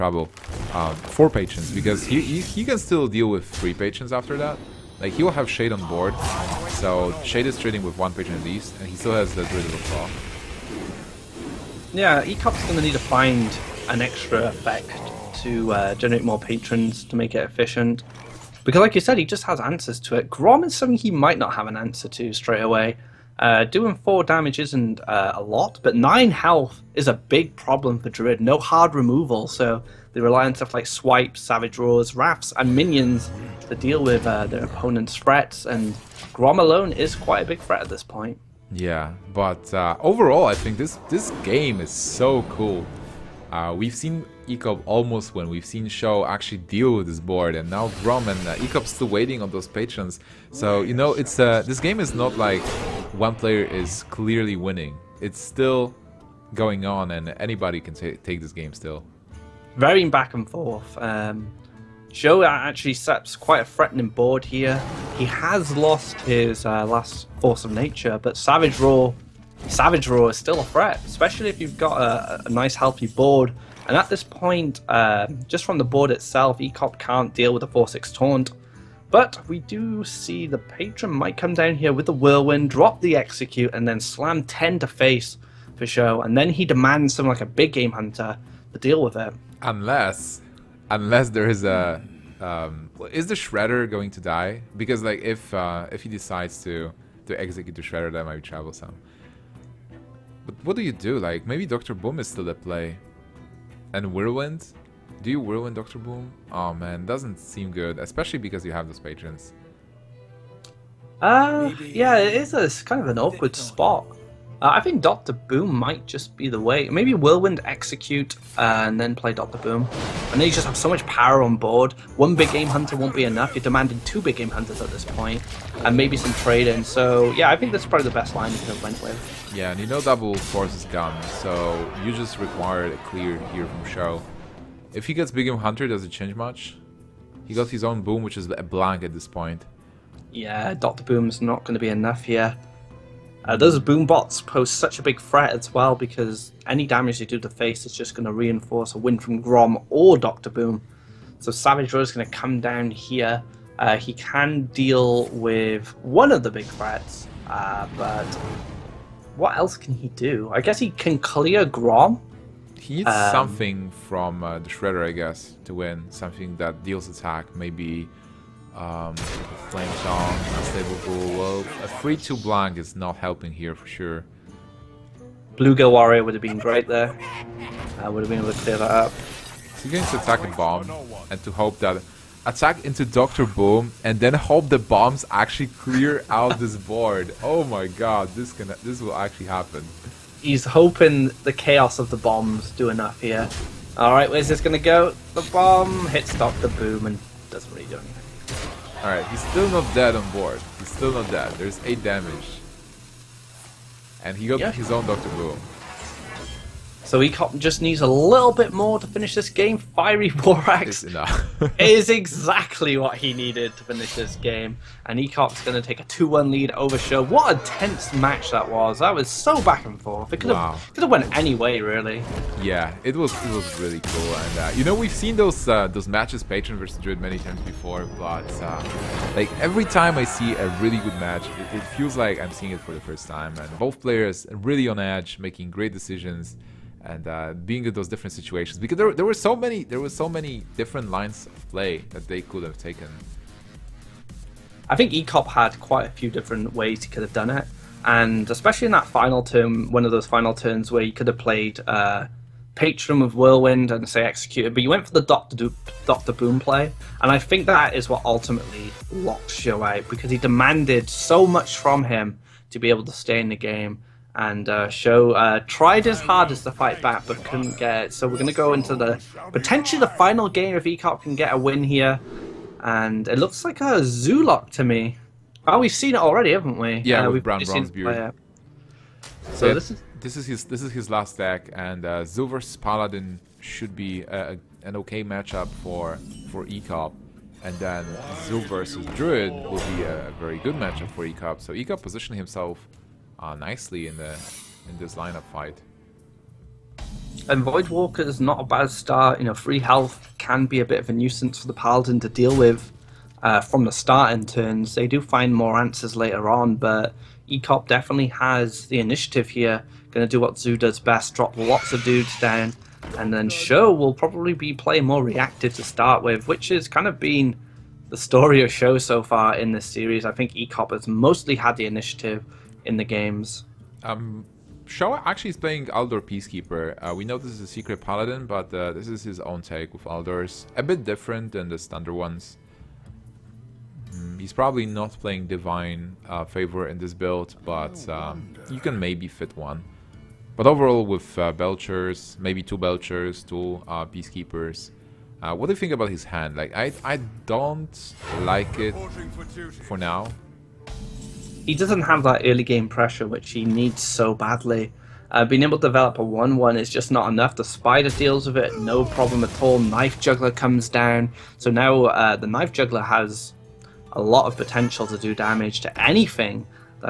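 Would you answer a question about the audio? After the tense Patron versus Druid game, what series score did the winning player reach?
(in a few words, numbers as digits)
2-1.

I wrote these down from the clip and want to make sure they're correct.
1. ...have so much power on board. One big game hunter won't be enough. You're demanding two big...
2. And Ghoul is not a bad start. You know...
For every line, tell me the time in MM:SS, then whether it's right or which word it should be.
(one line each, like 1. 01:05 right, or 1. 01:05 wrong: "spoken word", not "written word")
1. 02:00 right
2. 04:57 wrong: "Voidwalker", not "Ghoul".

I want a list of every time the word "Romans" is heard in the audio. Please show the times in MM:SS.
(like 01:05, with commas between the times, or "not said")
not said.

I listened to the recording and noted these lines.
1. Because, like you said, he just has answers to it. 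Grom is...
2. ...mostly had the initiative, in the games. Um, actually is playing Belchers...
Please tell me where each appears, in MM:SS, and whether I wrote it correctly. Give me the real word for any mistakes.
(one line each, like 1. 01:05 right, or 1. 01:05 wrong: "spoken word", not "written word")
1. 00:18 right
2. 05:21 wrong: "Aldor", not "Belchers".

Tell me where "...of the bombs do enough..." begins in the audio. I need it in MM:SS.
03:11.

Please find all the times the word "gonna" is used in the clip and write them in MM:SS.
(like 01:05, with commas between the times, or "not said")
00:12, 03:14.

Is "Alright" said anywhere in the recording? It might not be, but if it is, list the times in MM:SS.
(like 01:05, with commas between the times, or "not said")
03:13, 03:19.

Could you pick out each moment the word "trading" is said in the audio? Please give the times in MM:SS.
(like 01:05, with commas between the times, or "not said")
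00:07, 02:06.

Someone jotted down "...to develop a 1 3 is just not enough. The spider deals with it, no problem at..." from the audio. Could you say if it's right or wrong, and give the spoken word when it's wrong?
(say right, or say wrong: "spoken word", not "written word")
wrong: "1", not "3".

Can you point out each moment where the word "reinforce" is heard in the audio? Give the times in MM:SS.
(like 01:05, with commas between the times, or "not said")
02:28.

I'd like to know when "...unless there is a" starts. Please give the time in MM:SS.
01:30.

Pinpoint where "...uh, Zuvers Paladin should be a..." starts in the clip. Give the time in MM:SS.
04:42.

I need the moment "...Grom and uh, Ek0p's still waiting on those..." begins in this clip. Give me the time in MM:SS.
00:48.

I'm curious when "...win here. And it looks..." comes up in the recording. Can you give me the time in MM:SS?
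04:31.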